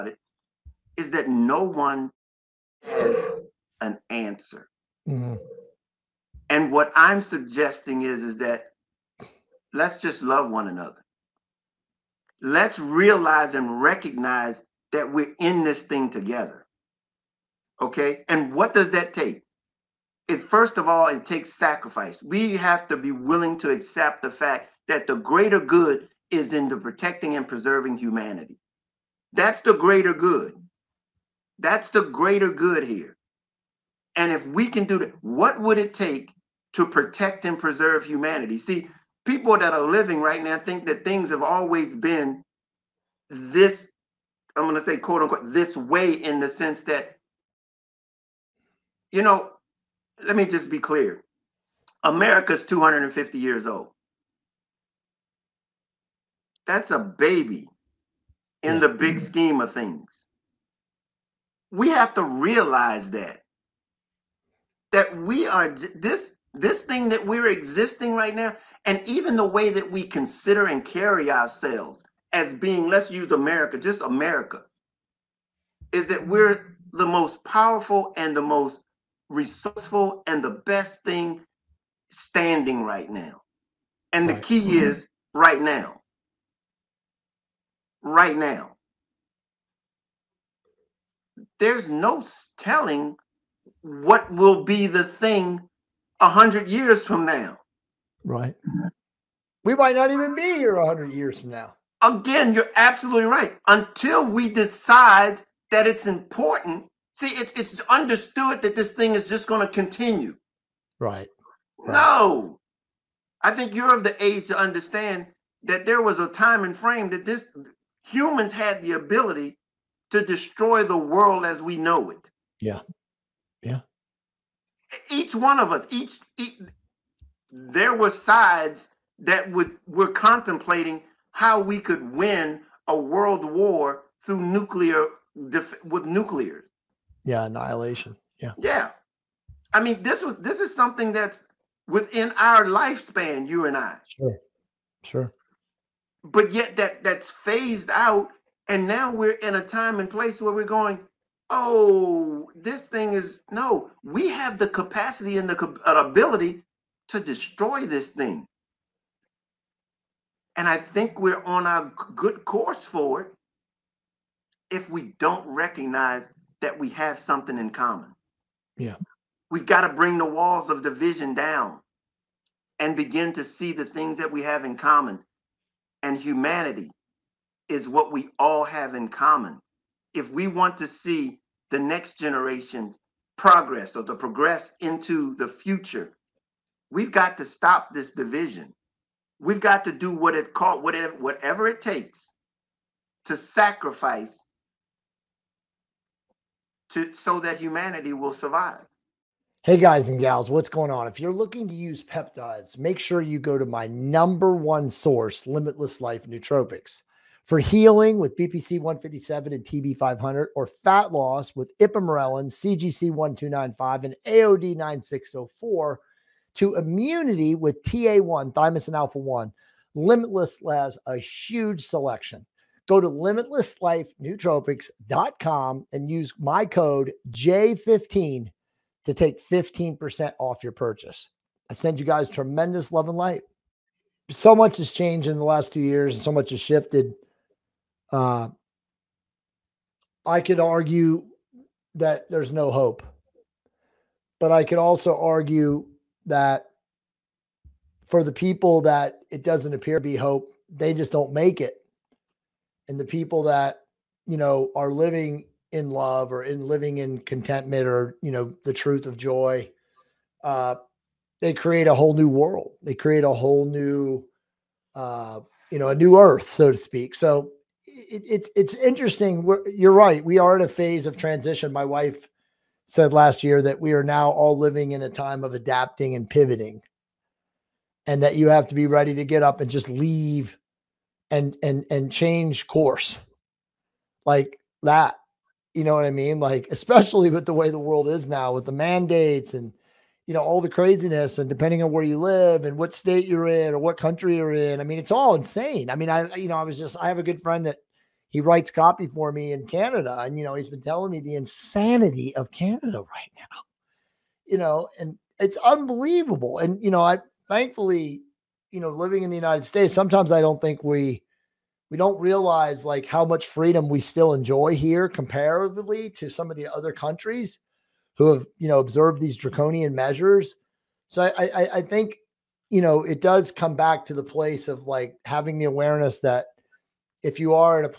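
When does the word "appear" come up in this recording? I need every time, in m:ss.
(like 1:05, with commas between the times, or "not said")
4:09.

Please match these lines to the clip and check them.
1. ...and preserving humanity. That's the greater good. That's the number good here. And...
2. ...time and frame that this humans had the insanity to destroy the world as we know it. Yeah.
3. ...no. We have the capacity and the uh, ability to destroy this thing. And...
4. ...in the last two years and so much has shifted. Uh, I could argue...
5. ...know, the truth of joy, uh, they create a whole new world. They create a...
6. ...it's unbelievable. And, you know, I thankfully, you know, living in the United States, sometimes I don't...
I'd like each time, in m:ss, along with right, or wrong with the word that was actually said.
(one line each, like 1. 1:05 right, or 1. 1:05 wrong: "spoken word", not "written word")
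1. 0:27 wrong: "greater", not "number"
2. 1:56 wrong: "ability", not "insanity"
3. 2:33 right
4. 3:55 right
5. 4:18 right
6. 5:05 right.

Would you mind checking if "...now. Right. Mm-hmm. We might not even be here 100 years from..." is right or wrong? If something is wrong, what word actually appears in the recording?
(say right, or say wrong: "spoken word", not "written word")
right.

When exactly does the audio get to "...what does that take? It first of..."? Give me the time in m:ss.
0:18.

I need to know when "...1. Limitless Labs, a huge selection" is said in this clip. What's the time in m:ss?
3:39.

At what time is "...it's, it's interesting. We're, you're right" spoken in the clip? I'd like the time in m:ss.
4:28.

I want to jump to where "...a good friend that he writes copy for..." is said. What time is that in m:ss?
4:57.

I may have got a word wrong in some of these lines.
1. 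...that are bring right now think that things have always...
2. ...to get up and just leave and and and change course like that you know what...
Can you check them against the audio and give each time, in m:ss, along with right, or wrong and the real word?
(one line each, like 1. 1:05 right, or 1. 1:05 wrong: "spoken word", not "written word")
1. 0:39 wrong: "living", not "bring"
2. 4:39 right.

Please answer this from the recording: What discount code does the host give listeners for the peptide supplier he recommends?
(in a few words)
J15.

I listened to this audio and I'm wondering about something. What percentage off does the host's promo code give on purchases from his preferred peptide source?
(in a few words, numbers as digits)
15%.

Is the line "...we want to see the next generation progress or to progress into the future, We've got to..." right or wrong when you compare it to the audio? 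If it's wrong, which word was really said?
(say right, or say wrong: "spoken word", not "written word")
right.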